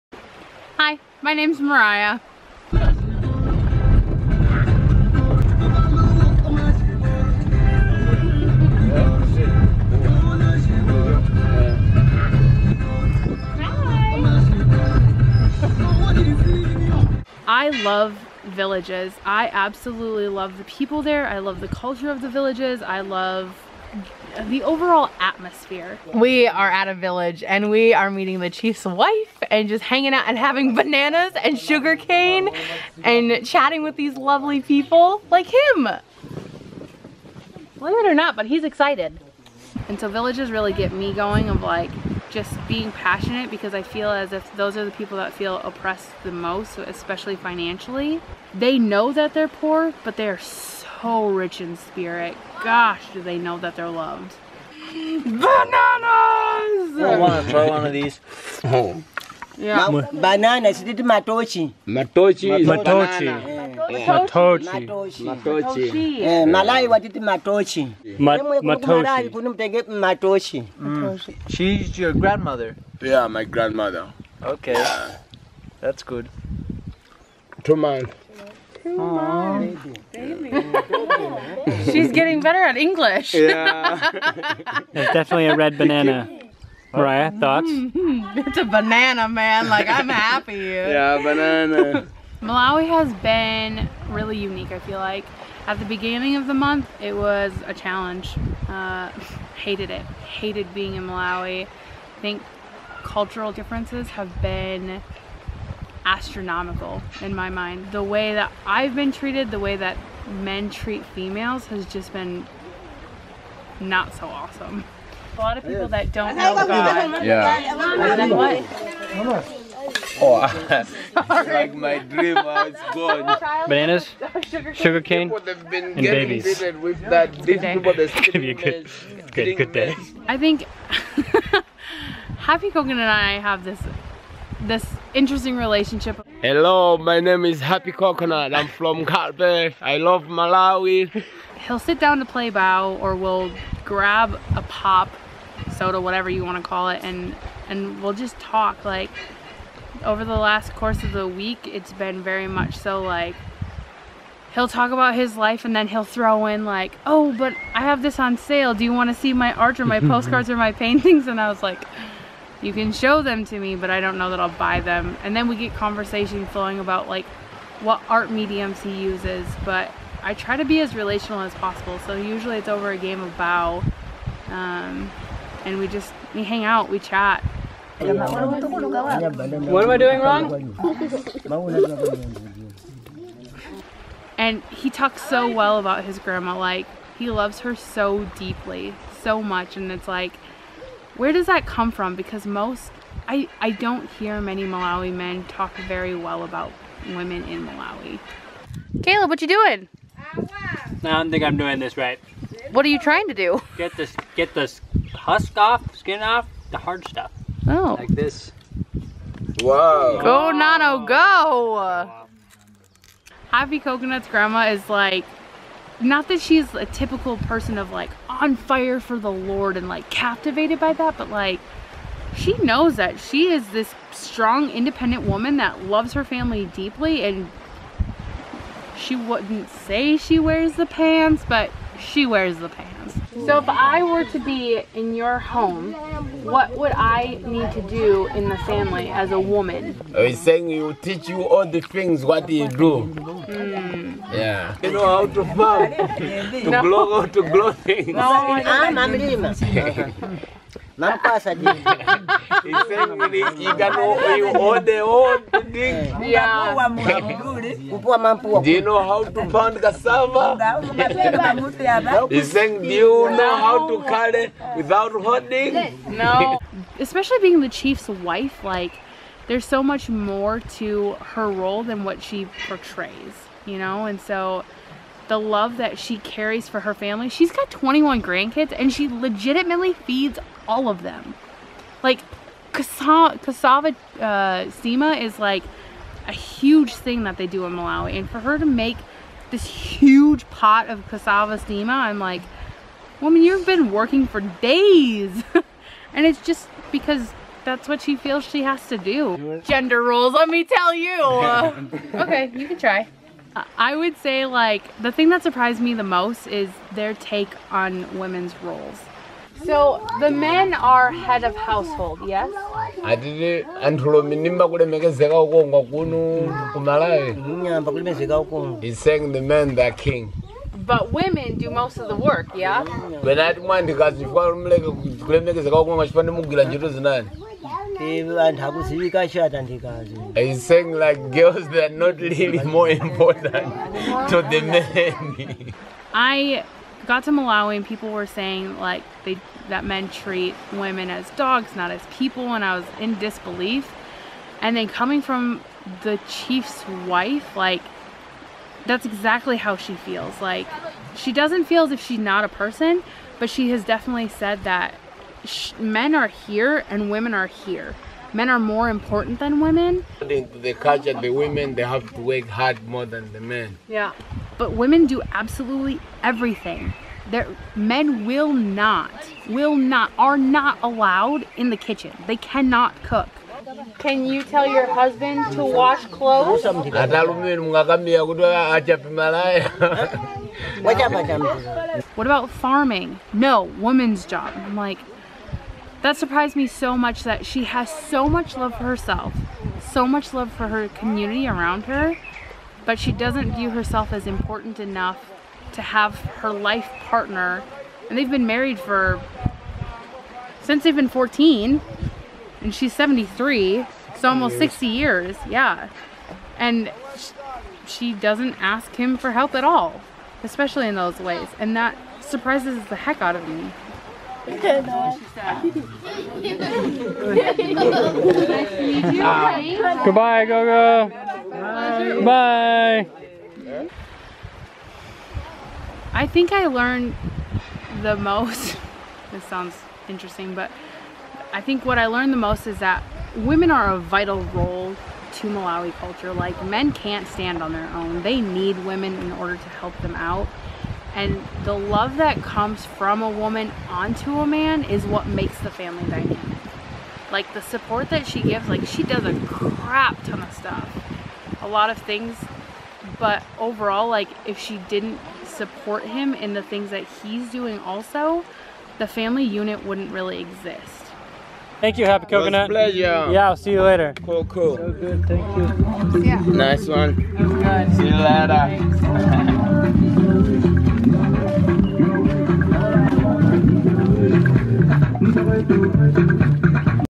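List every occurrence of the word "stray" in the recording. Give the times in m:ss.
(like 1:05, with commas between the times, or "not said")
not said.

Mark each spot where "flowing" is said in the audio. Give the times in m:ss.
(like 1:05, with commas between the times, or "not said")
2:46.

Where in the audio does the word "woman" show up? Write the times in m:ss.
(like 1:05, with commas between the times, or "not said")
3:45, 3:59, 4:53, 6:23, 7:23.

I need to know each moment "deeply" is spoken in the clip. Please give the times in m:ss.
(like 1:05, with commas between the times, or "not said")
3:08, 3:46.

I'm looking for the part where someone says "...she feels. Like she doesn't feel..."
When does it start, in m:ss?
5:49.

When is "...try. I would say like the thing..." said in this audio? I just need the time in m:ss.
5:02.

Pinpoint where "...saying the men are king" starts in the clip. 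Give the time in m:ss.
5:18.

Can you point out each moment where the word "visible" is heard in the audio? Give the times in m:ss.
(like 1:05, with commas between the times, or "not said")
not said.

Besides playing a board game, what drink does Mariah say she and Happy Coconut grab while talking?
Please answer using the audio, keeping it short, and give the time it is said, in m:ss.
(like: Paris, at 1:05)
pop soda, at 2:24.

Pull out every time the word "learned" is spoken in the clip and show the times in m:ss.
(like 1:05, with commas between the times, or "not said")
7:06, 7:12.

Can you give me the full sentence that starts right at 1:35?
At the beginning of the month, it was a challenge.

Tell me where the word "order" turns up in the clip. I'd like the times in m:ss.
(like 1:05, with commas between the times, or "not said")
7:19.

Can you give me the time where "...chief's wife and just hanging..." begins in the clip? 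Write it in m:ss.
0:28.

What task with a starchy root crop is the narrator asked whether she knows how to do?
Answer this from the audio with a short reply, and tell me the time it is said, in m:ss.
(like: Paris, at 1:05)
pound cassava, at 4:19.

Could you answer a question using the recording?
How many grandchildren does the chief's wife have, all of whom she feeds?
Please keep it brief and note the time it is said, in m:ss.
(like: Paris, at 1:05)
21, at 4:37.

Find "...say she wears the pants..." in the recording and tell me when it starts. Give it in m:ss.
3:49.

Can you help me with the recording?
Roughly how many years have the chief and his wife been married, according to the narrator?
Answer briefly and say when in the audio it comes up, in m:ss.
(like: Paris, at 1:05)
almost 60 years, at 6:44.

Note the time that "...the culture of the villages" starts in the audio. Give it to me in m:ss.
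0:21.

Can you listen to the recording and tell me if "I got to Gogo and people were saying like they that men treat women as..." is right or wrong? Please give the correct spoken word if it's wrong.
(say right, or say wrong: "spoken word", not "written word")
wrong: "Malawi", not "Gogo".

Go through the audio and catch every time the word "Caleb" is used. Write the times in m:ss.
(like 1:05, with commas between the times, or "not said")
3:19.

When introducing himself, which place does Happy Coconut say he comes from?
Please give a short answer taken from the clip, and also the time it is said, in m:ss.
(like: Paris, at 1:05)
Carpe, at 2:19.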